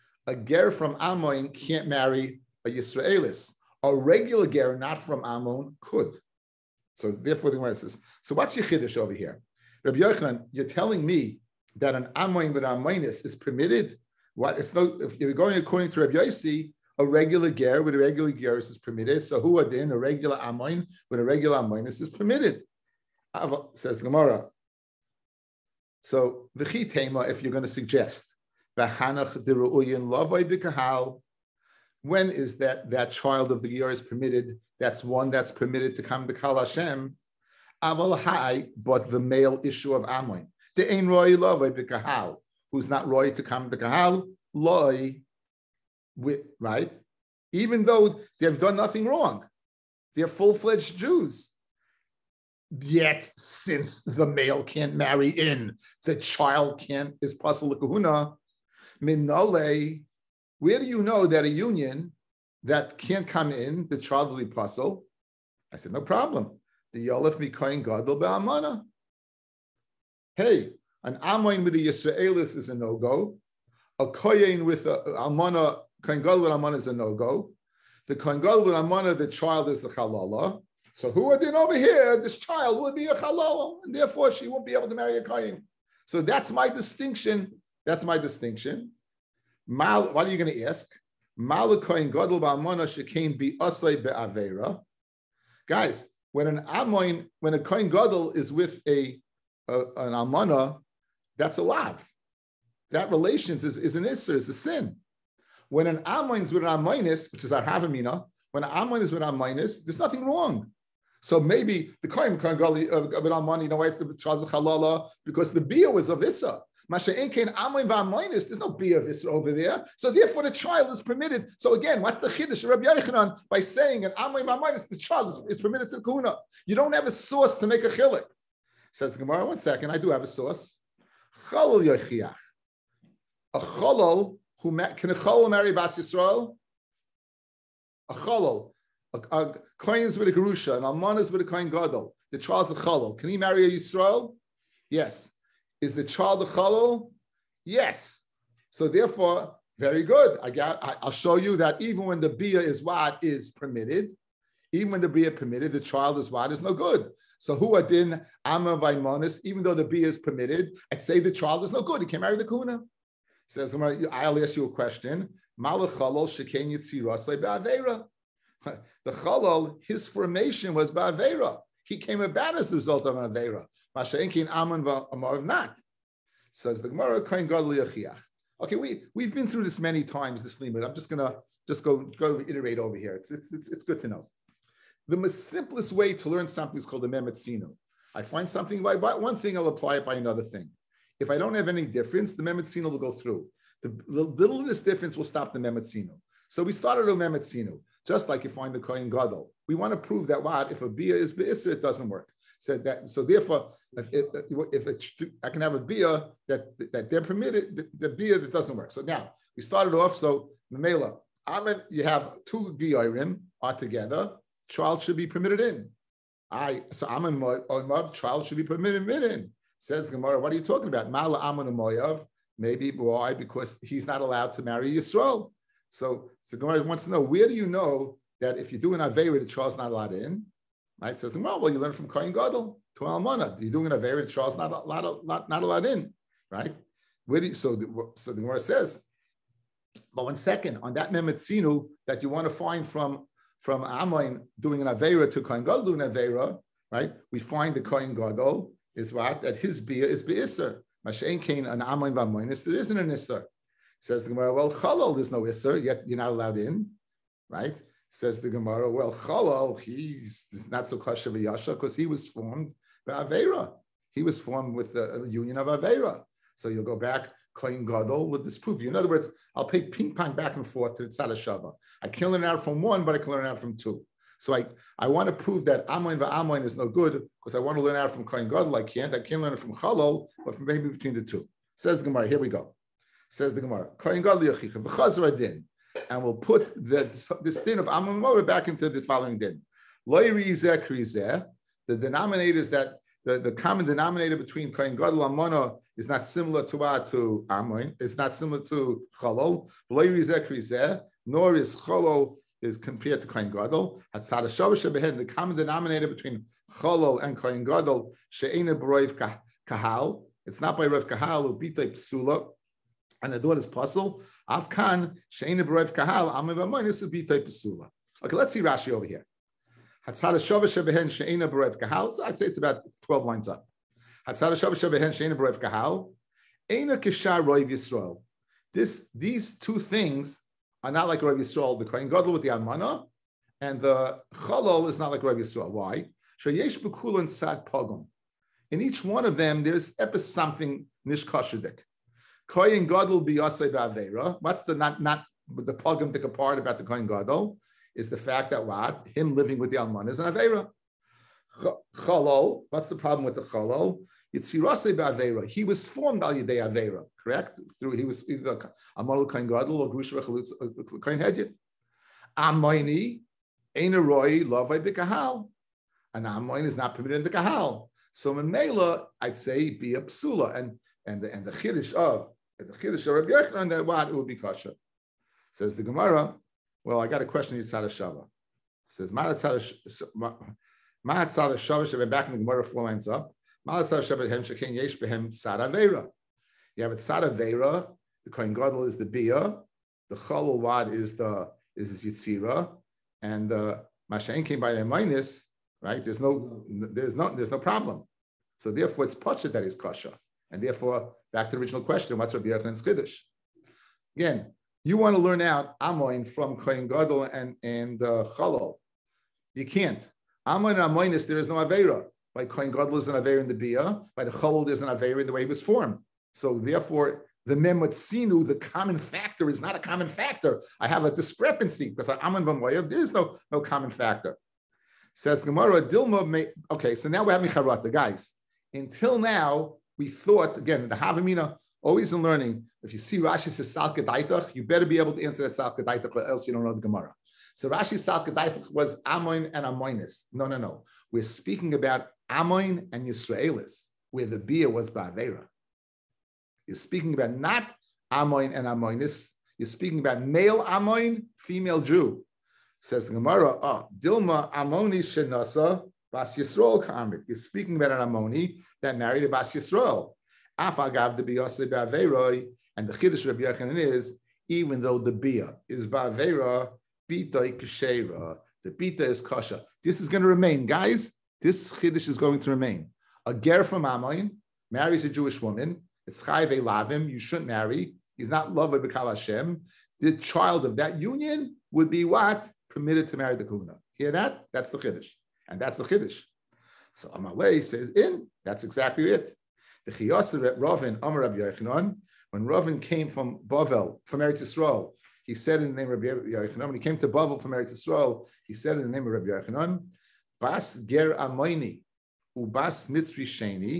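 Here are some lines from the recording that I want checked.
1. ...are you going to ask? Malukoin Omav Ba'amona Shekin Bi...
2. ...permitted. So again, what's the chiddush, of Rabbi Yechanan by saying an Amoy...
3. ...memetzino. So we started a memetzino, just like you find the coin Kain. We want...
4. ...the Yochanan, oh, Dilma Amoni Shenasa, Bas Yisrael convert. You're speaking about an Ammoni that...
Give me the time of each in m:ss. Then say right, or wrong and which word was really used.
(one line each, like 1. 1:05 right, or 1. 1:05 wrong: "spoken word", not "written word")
1. 1:30 wrong: "Godel", not "Omav"
2. 2:01 right
3. 3:15 wrong: "Gadol", not "Kain"
4. 7:33 wrong: "Gemara", not "Yochanan".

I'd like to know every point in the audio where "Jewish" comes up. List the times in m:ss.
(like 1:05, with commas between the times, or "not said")
7:55.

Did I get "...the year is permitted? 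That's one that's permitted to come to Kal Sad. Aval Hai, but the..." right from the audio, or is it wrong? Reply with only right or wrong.
wrong.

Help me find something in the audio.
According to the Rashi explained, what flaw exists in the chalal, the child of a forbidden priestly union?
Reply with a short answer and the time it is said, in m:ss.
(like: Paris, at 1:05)
Yitzirasei ba'aveira, at 5:54.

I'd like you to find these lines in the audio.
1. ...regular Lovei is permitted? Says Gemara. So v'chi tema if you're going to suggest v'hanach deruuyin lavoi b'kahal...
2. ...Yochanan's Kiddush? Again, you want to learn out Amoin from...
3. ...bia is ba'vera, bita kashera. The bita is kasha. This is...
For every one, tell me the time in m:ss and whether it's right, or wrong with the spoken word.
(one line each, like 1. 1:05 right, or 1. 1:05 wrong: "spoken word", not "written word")
1. 0:21 wrong: "Amoinis", not "Lovei"
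2. 6:42 right
3. 7:45 right.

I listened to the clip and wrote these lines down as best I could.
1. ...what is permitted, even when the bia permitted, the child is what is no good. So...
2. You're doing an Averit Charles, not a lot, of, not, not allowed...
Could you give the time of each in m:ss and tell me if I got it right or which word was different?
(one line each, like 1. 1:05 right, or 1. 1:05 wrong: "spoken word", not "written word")
1. 2:32 right
2. 3:53 right.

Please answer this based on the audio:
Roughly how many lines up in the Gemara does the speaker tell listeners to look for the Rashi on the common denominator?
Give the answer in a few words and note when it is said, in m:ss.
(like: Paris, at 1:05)
12, at 5:23.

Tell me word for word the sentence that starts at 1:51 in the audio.
So maybe the coin Kohen Gadol of an Amon, you know why it's the chazal Halala?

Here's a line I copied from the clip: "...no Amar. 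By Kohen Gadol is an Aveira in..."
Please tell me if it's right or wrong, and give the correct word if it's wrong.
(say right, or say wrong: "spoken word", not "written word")
wrong: "Aveira", not "Amar".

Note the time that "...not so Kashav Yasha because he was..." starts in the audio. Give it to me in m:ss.
4:20.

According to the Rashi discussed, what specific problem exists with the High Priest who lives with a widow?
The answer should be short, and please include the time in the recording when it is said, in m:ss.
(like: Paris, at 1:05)
biyasei ba'aveira, at 5:42.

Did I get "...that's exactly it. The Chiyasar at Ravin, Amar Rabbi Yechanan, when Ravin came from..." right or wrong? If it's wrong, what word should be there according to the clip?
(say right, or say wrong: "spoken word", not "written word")
right.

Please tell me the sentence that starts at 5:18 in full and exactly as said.
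Okay, let's see Rashi over here.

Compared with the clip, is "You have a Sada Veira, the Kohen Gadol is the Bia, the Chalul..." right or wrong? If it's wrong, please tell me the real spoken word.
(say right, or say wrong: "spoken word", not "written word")
right.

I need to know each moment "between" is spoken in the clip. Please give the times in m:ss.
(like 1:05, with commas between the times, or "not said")
4:40, 4:54, 5:06.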